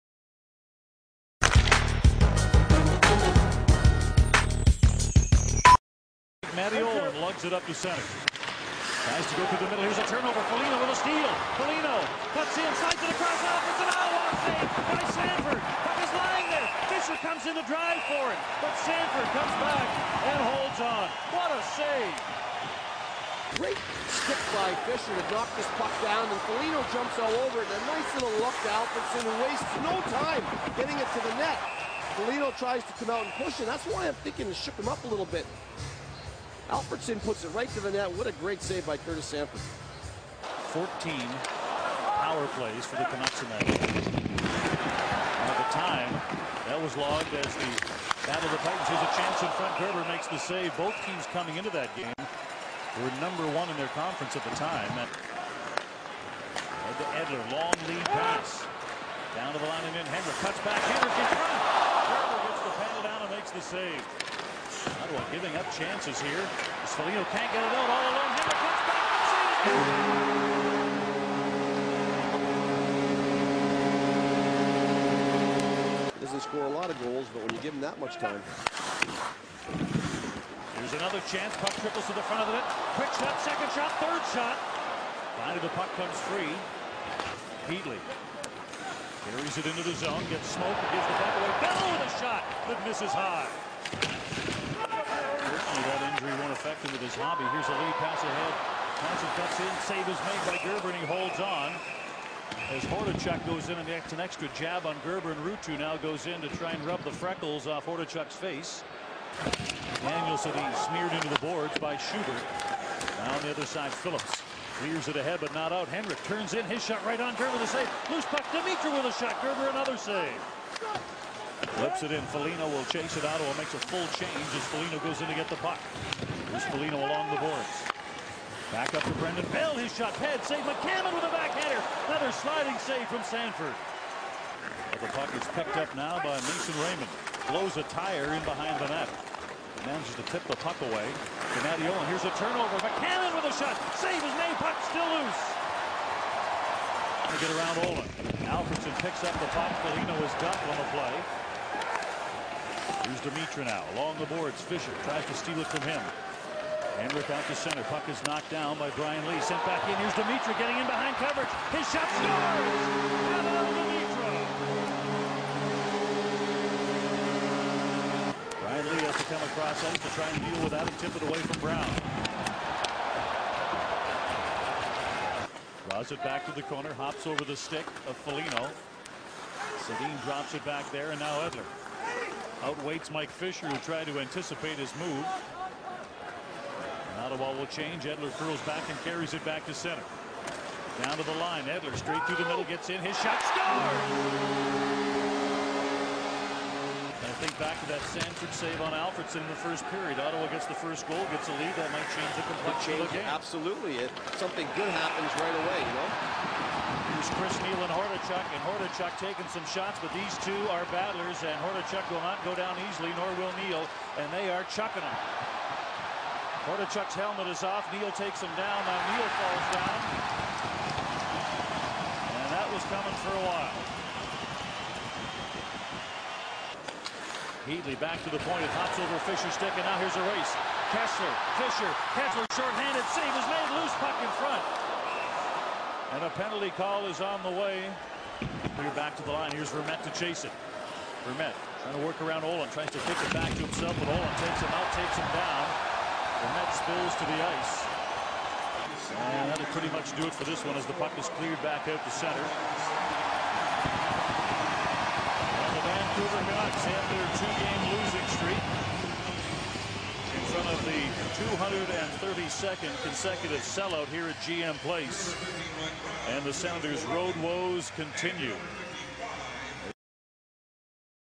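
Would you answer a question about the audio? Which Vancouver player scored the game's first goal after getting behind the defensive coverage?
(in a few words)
Pavol Demitra.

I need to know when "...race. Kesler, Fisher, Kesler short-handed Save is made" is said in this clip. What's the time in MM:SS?
03:50.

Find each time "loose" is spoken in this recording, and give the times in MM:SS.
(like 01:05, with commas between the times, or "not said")
01:58, 02:25, 03:53.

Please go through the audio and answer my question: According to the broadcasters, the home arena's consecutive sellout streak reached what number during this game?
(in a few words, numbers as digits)
132nd.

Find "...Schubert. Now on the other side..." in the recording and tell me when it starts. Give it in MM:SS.
01:51.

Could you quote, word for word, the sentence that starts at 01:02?
Gerber gets the panel down and makes the save.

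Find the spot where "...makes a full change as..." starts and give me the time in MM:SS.
02:03.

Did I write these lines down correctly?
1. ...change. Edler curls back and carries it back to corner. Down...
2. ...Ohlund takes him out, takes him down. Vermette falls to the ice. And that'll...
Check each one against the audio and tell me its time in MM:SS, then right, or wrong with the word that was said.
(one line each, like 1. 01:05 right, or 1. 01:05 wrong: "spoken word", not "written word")
1. 03:07 wrong: "center", not "corner"
2. 04:04 wrong: "spills", not "falls".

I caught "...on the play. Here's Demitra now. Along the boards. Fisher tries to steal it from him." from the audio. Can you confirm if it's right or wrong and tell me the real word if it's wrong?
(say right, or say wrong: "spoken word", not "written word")
right.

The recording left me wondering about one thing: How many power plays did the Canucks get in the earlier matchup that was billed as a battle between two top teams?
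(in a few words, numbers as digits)
14.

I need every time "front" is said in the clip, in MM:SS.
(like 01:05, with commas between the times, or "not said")
00:49, 01:01, 01:22, 03:54.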